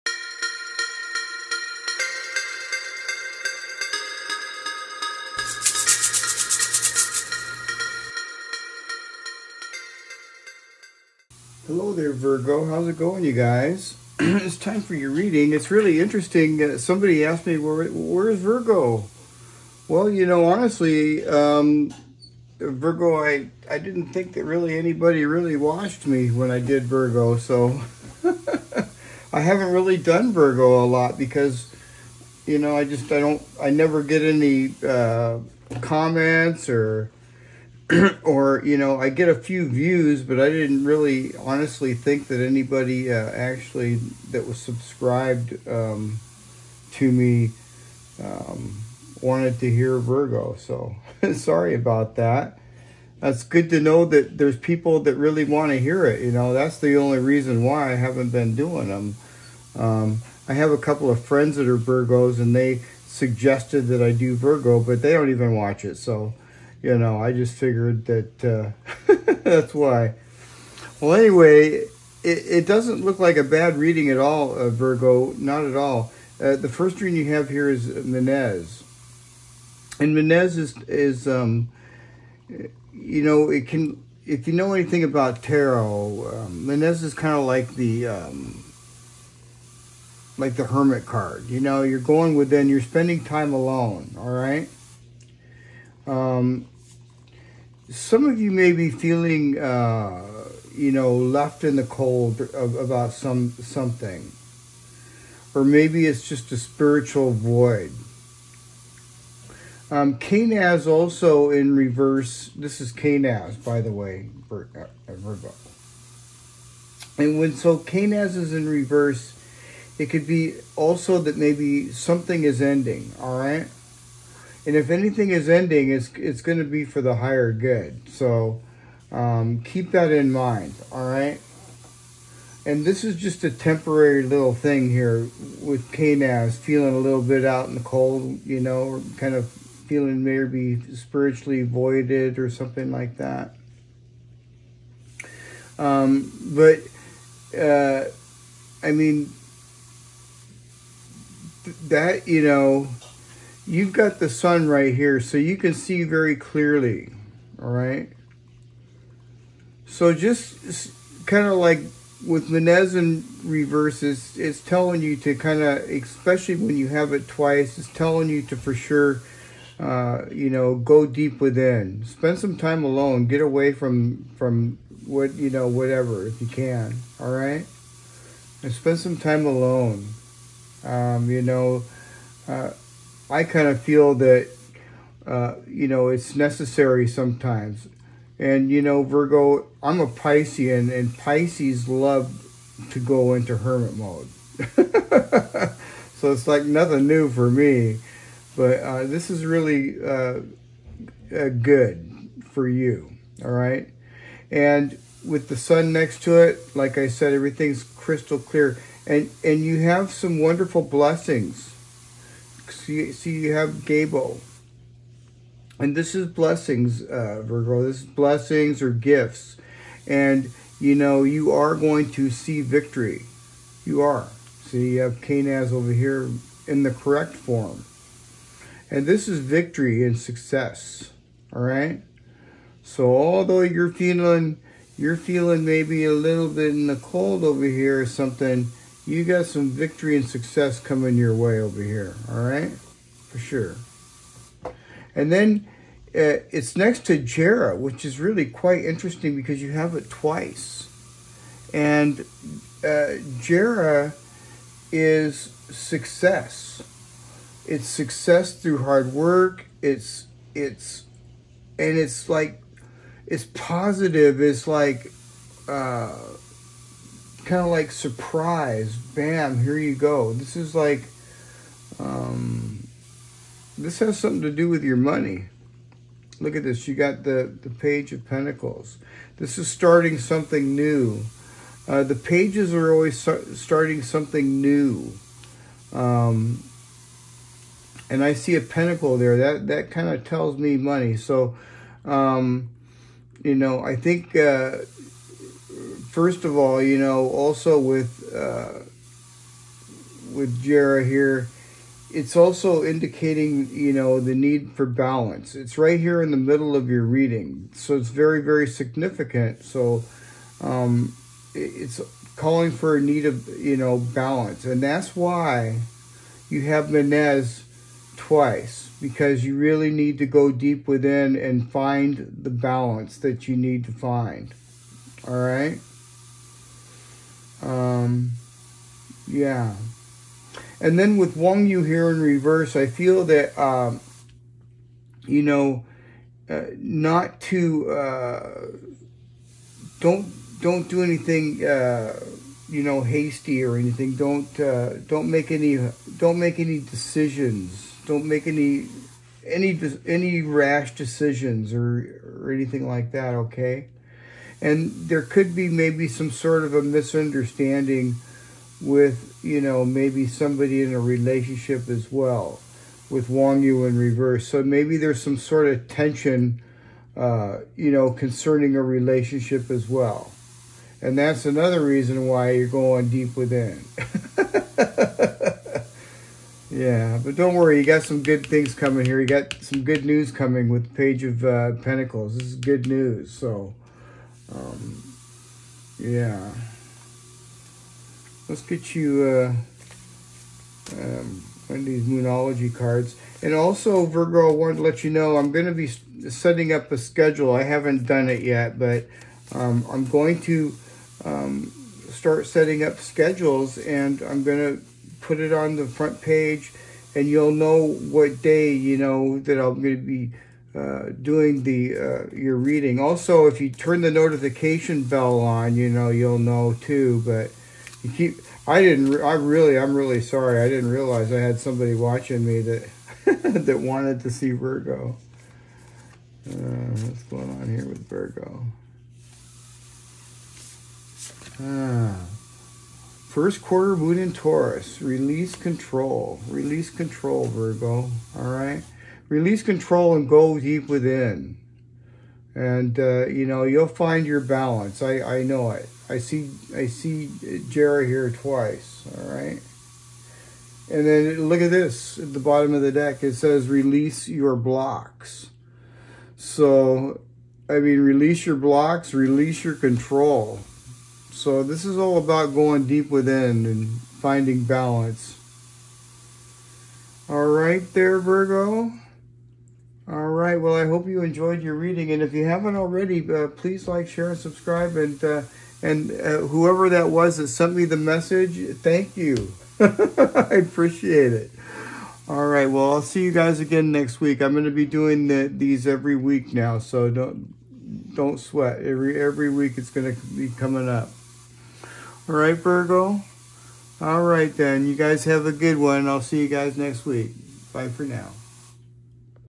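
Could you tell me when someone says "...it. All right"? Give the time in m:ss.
8:01.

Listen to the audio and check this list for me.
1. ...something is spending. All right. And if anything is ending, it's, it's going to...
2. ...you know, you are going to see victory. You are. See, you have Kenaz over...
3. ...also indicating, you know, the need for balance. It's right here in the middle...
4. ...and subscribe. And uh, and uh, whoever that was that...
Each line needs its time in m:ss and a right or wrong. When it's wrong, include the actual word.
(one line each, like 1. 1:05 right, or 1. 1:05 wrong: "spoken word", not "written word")
1. 2:01 wrong: "ending", not "spending"
2. 3:40 right
3. 5:02 right
4. 7:54 right.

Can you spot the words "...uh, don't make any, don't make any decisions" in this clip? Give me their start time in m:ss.
5:44.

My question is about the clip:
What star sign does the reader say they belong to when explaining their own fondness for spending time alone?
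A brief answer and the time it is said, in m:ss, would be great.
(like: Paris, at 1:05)
Pisces, at 3:09.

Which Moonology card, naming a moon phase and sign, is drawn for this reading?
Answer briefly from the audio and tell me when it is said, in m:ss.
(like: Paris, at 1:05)
First quarter moon in Taurus, at 7:13.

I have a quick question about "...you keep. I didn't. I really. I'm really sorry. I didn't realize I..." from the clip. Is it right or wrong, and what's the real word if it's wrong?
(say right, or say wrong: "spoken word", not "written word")
right.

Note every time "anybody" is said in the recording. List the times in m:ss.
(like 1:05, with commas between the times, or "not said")
0:24, 0:42.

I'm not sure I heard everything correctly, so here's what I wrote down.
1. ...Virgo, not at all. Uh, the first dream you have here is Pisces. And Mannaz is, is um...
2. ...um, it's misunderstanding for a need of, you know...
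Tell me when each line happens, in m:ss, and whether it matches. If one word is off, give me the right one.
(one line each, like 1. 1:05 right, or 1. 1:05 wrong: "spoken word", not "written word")
1. 1:14 wrong: "Mannaz", not "Pisces"
2. 5:10 wrong: "calling", not "misunderstanding".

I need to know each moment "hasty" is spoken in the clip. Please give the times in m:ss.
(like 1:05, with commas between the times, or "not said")
5:43.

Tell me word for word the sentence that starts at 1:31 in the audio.
You know, you're going within, you're spending time alone, all right?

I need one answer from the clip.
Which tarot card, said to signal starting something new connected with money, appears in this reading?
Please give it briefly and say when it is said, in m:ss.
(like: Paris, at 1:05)
Page of Pentacles, at 4:37.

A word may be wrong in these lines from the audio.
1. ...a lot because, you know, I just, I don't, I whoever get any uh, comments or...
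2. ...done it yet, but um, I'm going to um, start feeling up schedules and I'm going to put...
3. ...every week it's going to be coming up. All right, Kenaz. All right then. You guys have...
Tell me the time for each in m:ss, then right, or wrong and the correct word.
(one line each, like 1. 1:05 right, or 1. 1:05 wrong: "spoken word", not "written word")
1. 0:30 wrong: "never", not "whoever"
2. 6:38 wrong: "setting", not "feeling"
3. 8:09 wrong: "Virgo", not "Kenaz".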